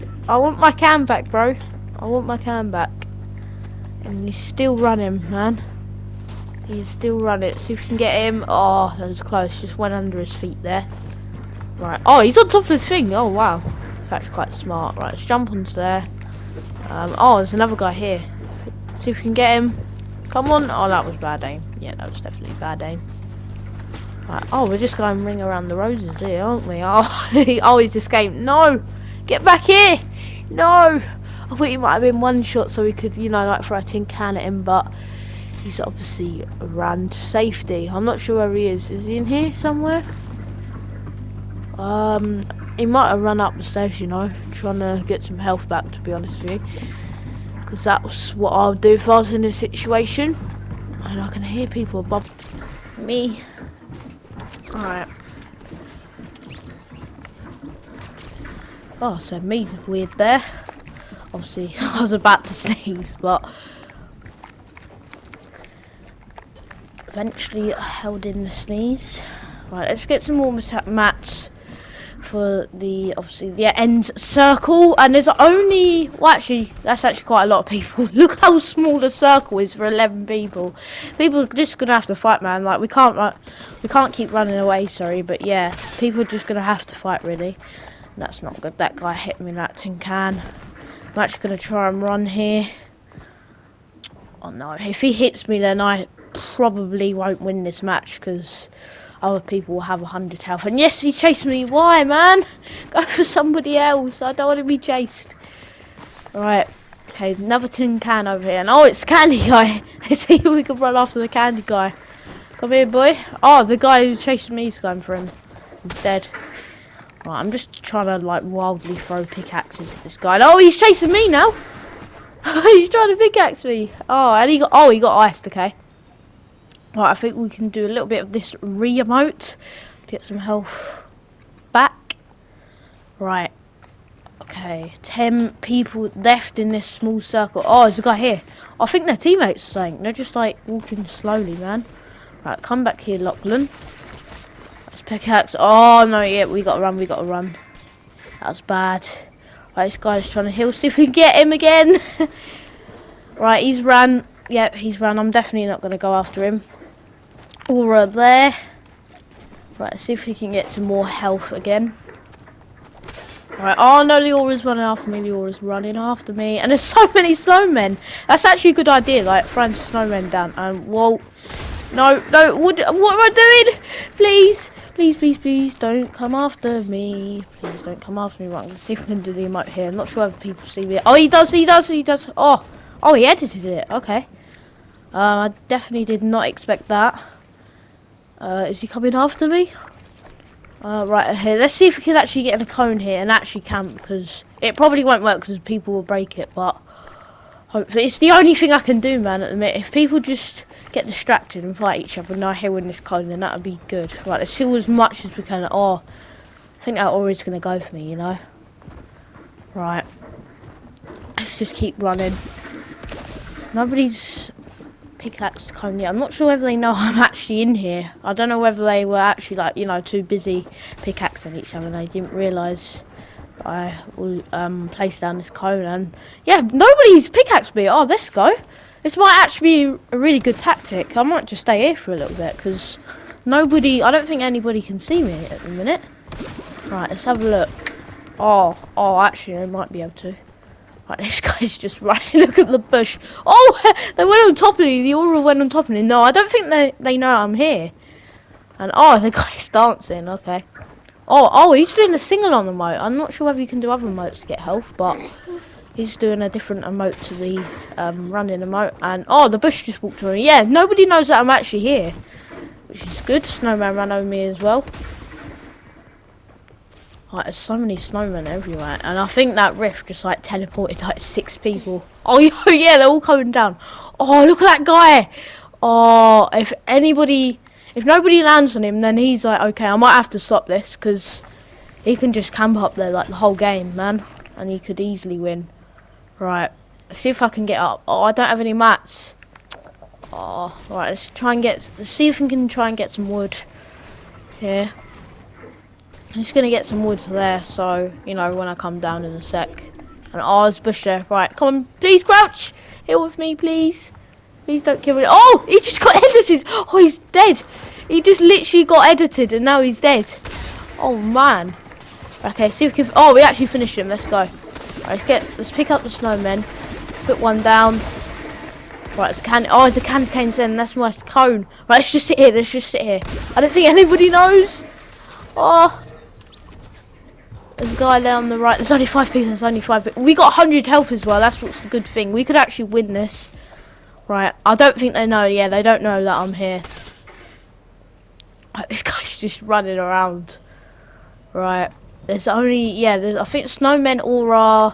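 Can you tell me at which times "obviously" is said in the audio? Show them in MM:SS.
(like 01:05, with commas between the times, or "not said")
00:35, 01:01, 01:13.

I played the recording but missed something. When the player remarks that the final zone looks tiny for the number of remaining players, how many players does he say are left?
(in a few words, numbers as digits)
11.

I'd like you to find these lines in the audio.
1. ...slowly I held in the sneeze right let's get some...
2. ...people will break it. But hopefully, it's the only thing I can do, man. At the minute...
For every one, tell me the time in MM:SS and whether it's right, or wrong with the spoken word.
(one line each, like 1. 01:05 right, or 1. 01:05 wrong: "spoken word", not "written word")
1. 01:07 wrong: "eventually", not "slowly"
2. 03:15 right.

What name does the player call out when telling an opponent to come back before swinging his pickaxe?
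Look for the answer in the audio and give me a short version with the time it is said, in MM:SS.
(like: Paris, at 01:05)
Lachlan, at 02:23.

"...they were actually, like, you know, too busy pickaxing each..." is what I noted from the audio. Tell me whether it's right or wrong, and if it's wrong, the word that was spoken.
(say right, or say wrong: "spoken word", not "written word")
right.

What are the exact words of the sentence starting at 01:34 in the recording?
Oh no, if he hits me then I probably won't win this match because other people will have 100 health.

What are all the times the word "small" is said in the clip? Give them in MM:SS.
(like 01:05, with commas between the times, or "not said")
01:18, 02:16.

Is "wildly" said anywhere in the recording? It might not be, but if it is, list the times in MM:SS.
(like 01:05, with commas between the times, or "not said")
01:58.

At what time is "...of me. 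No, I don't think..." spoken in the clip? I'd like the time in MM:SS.
04:05.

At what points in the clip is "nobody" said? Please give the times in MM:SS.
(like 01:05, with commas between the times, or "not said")
03:33, 03:46, 03:53, 04:20, 04:38.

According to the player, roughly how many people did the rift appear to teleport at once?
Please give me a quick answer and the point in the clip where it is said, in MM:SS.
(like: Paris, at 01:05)
6, at 04:31.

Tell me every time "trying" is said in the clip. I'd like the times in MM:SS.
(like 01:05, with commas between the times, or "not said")
00:44, 01:57, 02:02, 02:30.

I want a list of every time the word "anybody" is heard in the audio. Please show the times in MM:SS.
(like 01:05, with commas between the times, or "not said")
03:54, 04:36, 05:23.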